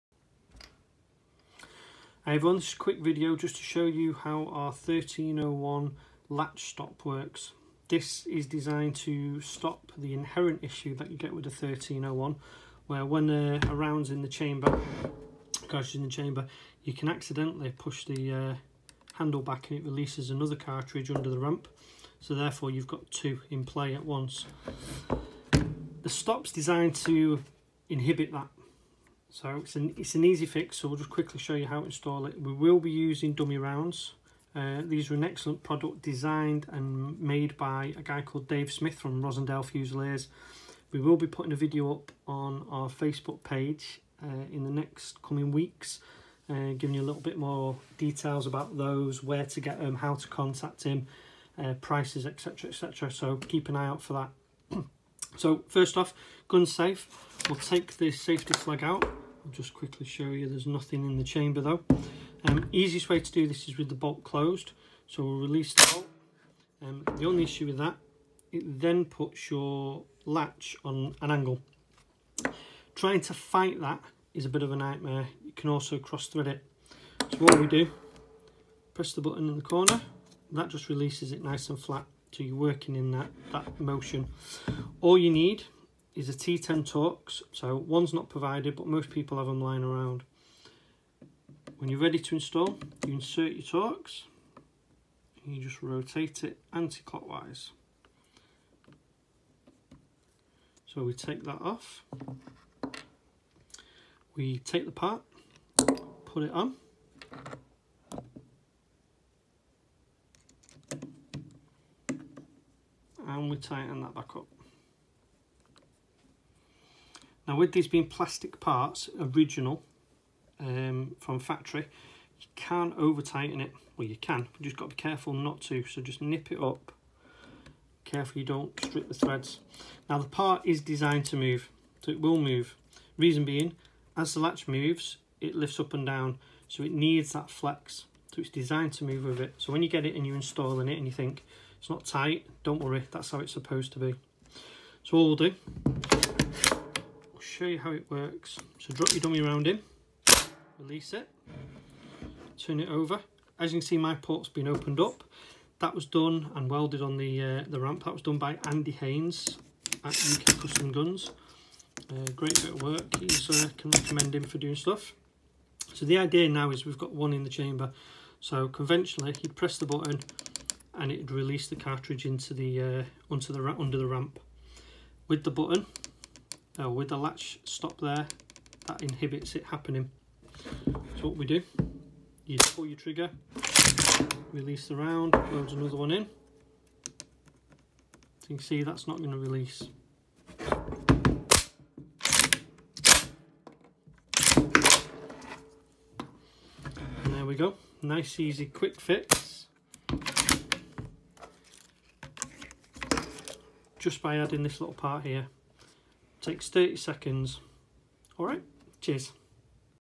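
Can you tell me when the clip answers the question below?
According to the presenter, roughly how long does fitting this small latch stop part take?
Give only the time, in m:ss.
3:26.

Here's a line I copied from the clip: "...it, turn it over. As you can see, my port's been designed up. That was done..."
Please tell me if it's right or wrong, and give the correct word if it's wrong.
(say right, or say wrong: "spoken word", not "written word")
wrong: "opened", not "designed".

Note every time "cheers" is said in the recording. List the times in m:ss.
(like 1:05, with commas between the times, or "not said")
3:28.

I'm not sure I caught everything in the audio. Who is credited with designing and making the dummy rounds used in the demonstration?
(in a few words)
Dave Smith.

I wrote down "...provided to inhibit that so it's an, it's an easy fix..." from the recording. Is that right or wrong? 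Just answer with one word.
wrong.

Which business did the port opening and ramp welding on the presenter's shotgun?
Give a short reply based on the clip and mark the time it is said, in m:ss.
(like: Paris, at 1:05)
UK Custom Guns, at 2:40.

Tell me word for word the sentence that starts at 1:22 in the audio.
So you're working in that, that motion.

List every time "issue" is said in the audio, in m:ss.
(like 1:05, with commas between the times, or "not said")
0:10, 1:07.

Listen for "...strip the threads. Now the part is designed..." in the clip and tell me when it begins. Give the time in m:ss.
2:08.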